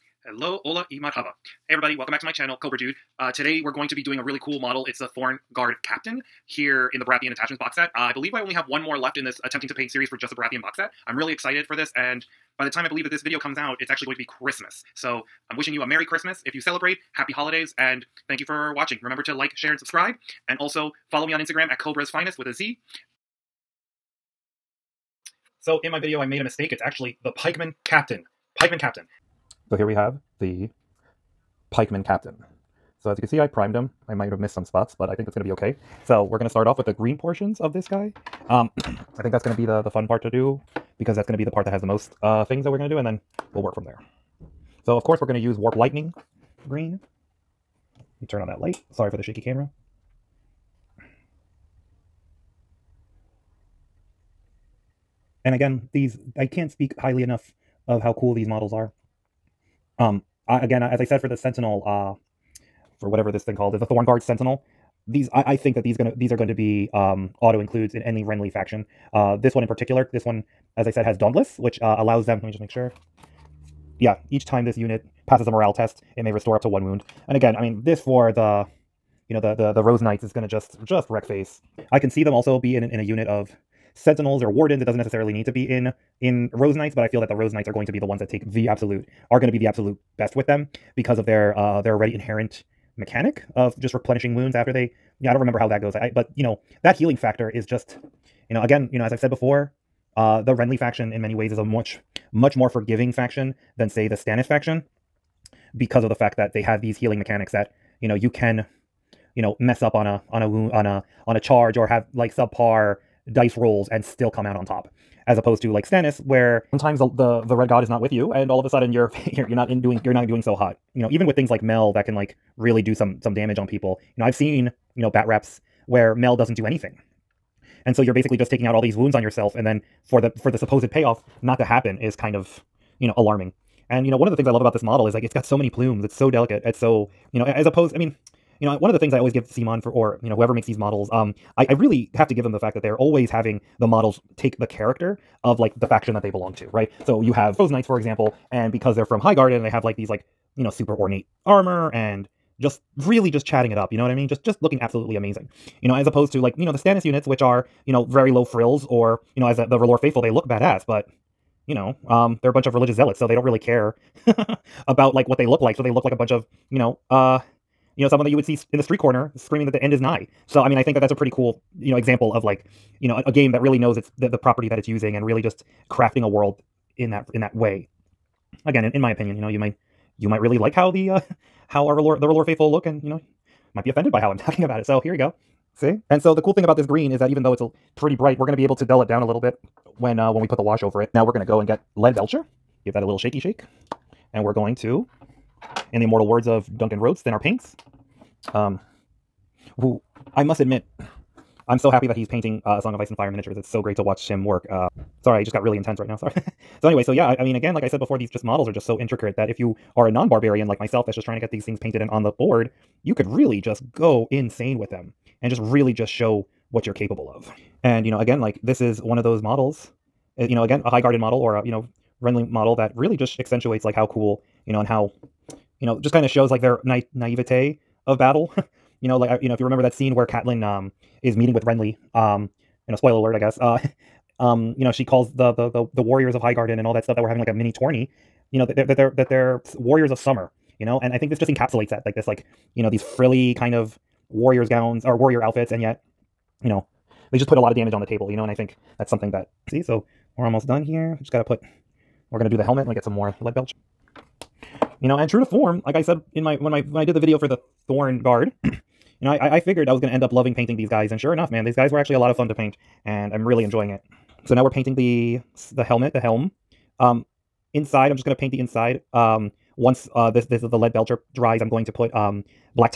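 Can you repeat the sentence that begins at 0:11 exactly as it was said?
I'm really excited for this and by the time I believe that this video comes out, it's actually going to be Christmas.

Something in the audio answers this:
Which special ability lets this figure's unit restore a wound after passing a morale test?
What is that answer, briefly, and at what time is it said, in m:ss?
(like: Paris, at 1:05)
Dauntless, at 1:11.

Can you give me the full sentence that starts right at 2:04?
You know, I've seen, you know, bat reps where Mel doesn't do anything.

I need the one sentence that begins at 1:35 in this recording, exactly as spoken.
I, I but you know that healing factor is just you know again you know as I've said before.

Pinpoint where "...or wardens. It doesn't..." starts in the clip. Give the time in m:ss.
1:24.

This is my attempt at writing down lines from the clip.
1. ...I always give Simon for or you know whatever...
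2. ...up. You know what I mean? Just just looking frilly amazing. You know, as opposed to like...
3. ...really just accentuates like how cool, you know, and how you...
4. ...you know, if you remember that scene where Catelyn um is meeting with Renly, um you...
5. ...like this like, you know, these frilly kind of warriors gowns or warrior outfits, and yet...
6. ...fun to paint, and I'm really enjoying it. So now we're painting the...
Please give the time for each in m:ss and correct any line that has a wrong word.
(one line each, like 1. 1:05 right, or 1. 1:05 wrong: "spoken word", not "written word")
1. 2:19 wrong: "whoever", not "whatever"
2. 2:33 wrong: "absolutely", not "frilly"
3. 3:42 right
4. 3:49 right
5. 4:02 right
6. 4:22 right.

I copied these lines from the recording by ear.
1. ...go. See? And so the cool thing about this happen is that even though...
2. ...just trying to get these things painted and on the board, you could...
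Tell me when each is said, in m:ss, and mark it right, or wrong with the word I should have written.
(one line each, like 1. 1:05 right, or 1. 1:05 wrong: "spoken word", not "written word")
1. 3:05 wrong: "green", not "happen"
2. 3:31 right.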